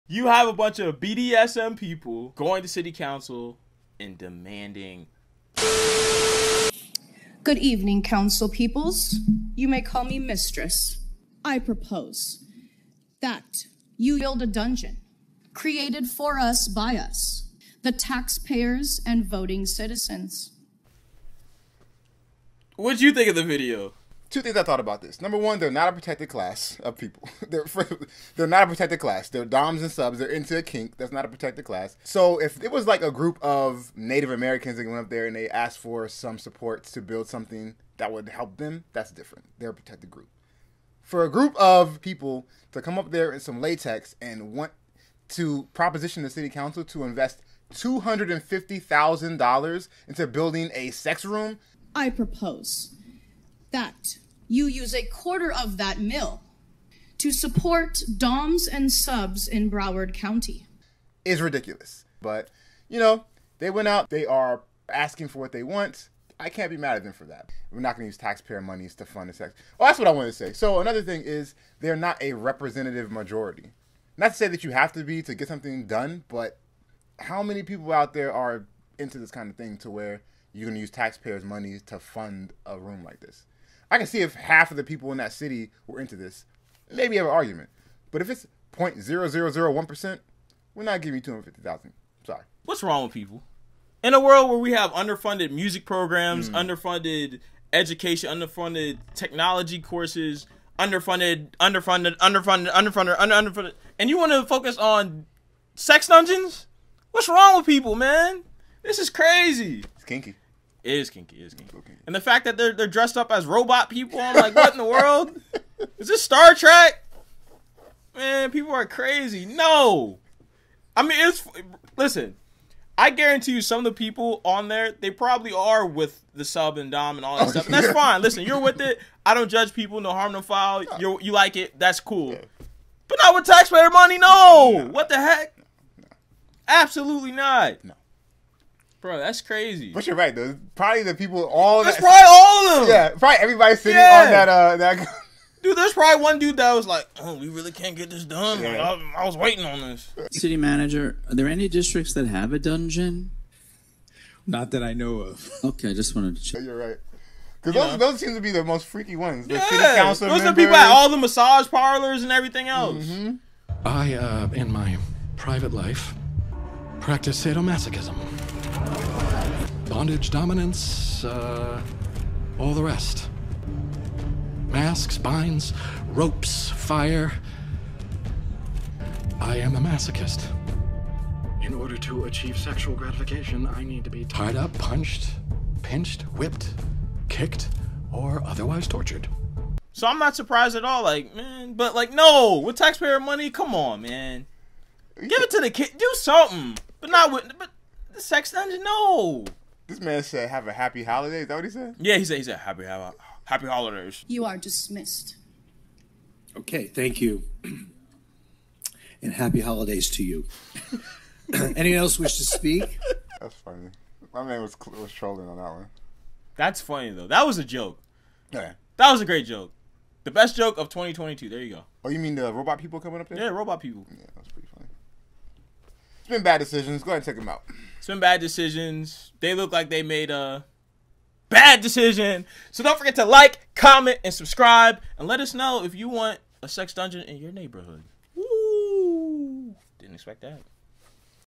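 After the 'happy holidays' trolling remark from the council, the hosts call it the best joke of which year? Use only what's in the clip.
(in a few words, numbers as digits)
2022.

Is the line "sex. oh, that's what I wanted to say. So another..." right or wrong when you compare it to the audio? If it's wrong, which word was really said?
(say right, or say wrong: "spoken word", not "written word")
right.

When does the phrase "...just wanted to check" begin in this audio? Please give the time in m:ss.
2:35.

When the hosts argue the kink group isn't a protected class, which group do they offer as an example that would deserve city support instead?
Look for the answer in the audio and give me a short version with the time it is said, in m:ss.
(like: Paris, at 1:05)
Native Americans, at 0:33.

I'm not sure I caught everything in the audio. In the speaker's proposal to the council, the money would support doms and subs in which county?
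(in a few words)
Broward County.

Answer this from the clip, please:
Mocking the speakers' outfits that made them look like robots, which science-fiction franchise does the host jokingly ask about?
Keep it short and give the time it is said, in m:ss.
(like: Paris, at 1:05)
Star Trek, at 1:56.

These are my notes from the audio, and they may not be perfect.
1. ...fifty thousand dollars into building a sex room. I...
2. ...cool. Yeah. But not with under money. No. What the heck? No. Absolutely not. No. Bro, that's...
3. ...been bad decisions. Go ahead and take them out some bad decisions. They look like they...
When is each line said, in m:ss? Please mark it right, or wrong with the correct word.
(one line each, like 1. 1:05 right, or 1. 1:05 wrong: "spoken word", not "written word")
1. 0:48 right
2. 2:11 wrong: "taxpayer", not "under"
3. 3:46 right.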